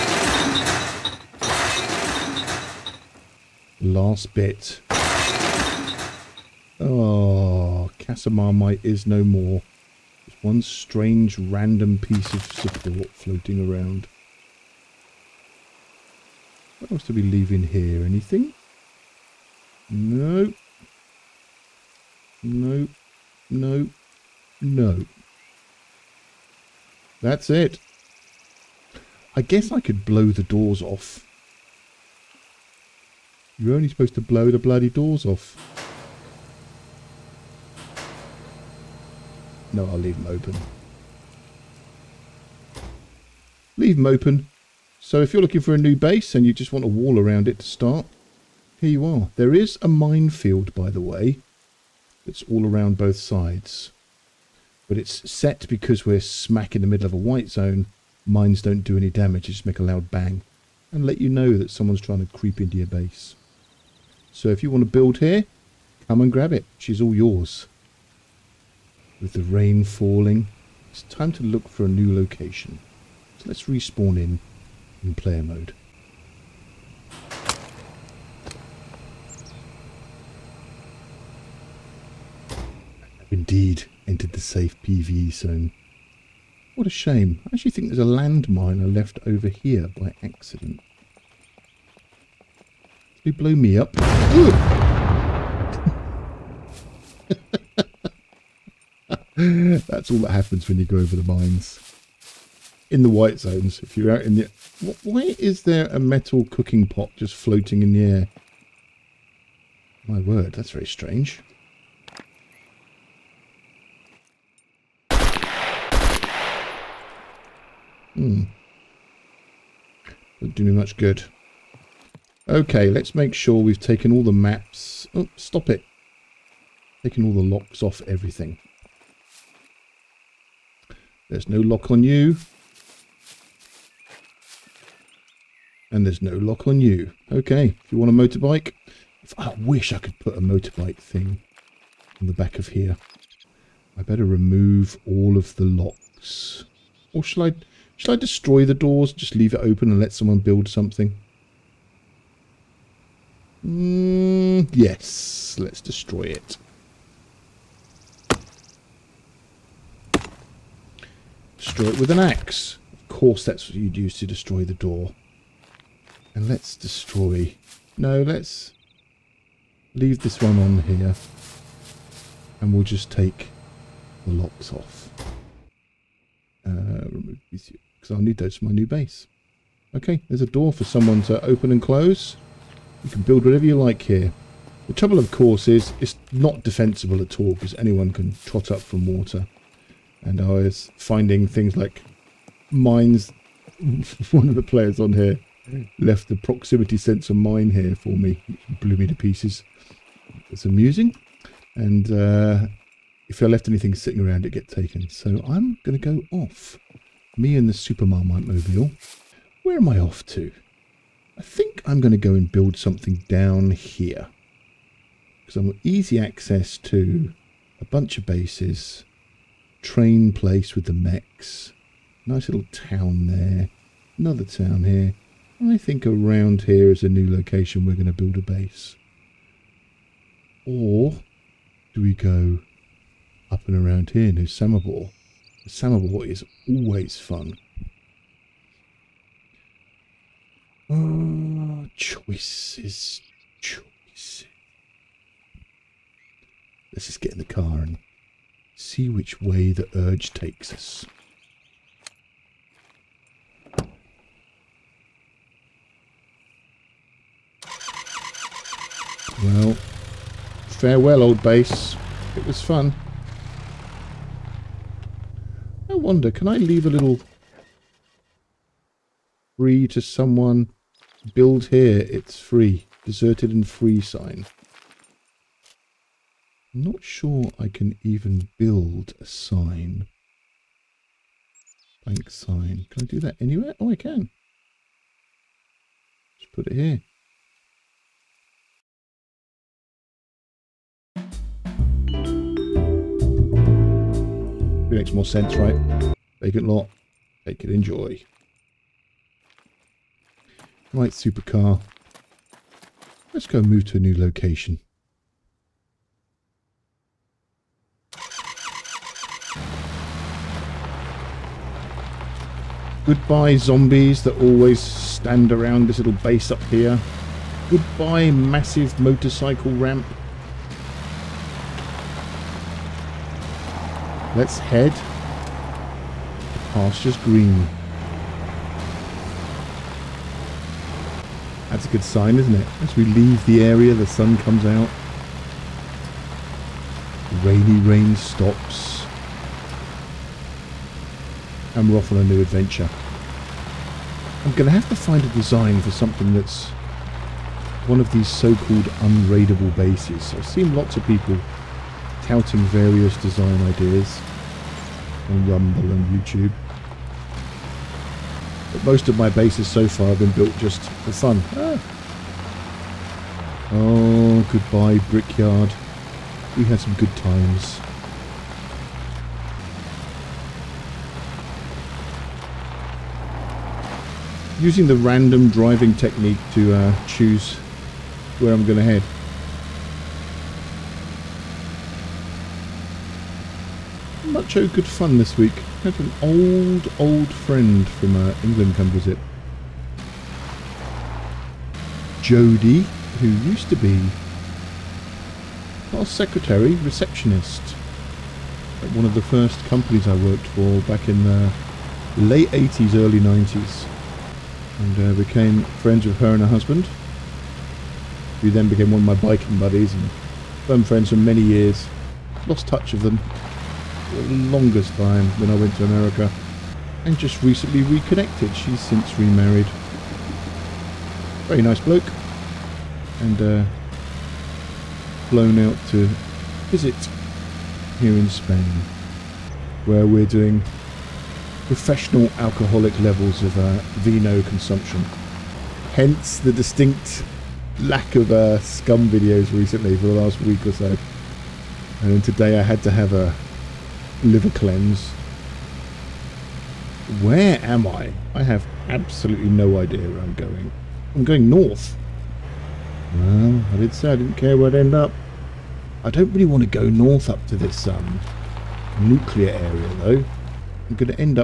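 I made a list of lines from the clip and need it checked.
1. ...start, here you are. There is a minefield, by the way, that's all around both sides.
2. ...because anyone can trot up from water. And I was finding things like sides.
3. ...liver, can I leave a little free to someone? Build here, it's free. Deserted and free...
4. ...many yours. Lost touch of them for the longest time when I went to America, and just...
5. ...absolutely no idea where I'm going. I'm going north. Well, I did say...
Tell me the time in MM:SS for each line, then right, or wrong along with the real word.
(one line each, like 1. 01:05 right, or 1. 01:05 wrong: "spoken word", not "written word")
1. 00:47 right
2. 03:07 wrong: "mines", not "sides"
3. 04:25 wrong: "wonder", not "liver"
4. 06:51 wrong: "years", not "yours"
5. 07:28 right.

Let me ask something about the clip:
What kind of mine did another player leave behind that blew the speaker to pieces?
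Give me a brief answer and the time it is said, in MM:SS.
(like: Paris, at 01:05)
Proximity sensor mine, at 03:16.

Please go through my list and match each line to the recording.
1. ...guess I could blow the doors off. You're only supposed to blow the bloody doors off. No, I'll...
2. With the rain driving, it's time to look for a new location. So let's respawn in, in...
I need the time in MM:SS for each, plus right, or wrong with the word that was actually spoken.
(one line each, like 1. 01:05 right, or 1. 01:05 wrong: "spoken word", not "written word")
1. 00:29 right
2. 01:09 wrong: "falling", not "driving".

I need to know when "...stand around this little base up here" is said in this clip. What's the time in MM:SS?
05:14.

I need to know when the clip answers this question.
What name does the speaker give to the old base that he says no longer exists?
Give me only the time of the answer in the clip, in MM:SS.
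00:07.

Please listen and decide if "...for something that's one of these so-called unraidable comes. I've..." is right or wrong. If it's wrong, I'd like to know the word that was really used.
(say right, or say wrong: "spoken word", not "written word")
wrong: "bases", not "comes".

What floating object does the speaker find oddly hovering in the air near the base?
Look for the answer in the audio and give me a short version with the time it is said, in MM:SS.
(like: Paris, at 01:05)
Metal cooking pot, at 01:45.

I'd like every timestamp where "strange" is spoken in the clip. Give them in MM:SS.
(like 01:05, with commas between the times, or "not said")
00:10, 01:50.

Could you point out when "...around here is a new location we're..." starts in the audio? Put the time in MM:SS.
03:46.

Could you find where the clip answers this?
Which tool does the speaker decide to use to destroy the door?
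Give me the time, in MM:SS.
02:42.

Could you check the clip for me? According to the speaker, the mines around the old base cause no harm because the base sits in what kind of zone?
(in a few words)
White zone.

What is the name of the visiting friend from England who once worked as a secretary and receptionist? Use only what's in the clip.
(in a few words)
Jodie.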